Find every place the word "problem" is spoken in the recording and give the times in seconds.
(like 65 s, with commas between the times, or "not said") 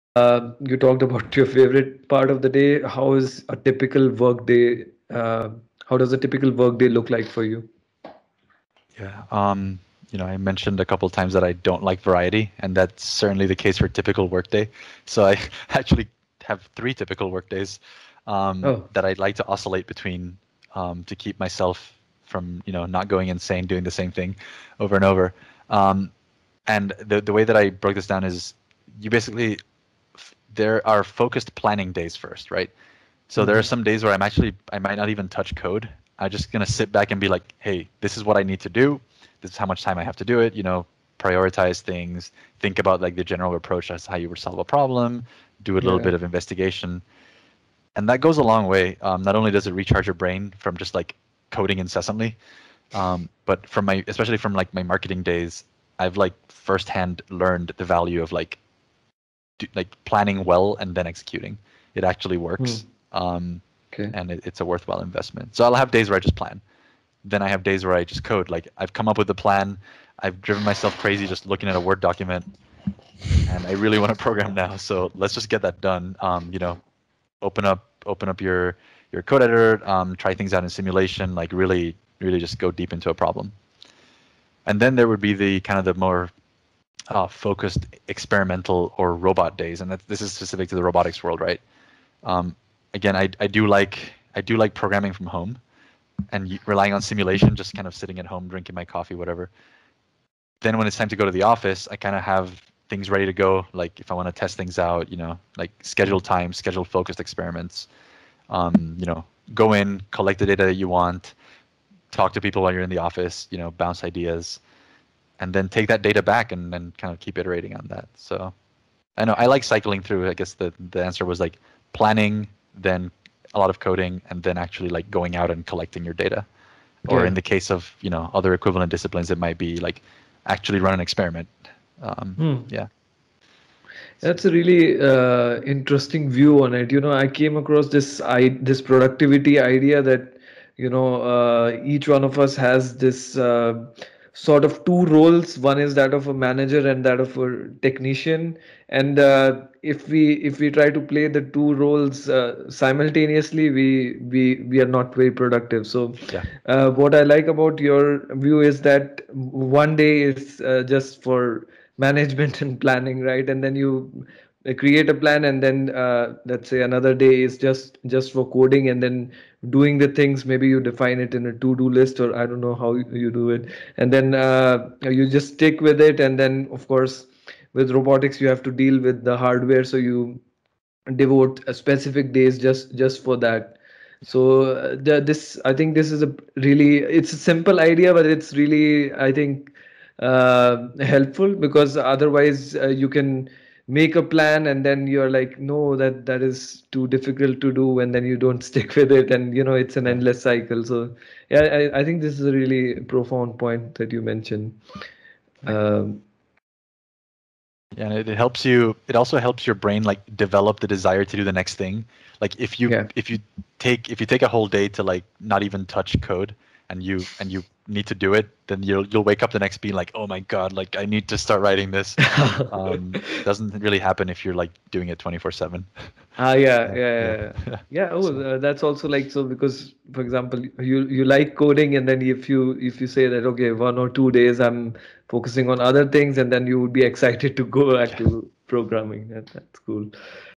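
44 s, 83 s.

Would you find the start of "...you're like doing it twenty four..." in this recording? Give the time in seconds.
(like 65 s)
224 s.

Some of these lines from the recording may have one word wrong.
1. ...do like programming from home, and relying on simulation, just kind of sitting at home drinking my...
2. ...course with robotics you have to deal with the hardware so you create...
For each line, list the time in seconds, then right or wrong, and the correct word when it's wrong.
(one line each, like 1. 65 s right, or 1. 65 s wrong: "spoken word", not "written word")
1. 94 s right
2. 176 s wrong: "devote", not "create".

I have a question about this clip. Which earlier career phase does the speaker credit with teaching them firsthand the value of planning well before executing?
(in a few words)
marketing days.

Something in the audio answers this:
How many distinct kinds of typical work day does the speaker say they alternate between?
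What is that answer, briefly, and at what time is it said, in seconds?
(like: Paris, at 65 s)
3, at 16 s.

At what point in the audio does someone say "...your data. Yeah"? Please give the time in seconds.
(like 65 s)
126 s.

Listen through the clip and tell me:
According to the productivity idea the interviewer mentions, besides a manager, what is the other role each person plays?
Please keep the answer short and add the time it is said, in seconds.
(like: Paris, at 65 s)
technician, at 147 s.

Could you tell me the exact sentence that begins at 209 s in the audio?
It also helps your brain like develop the desire to do the next thing.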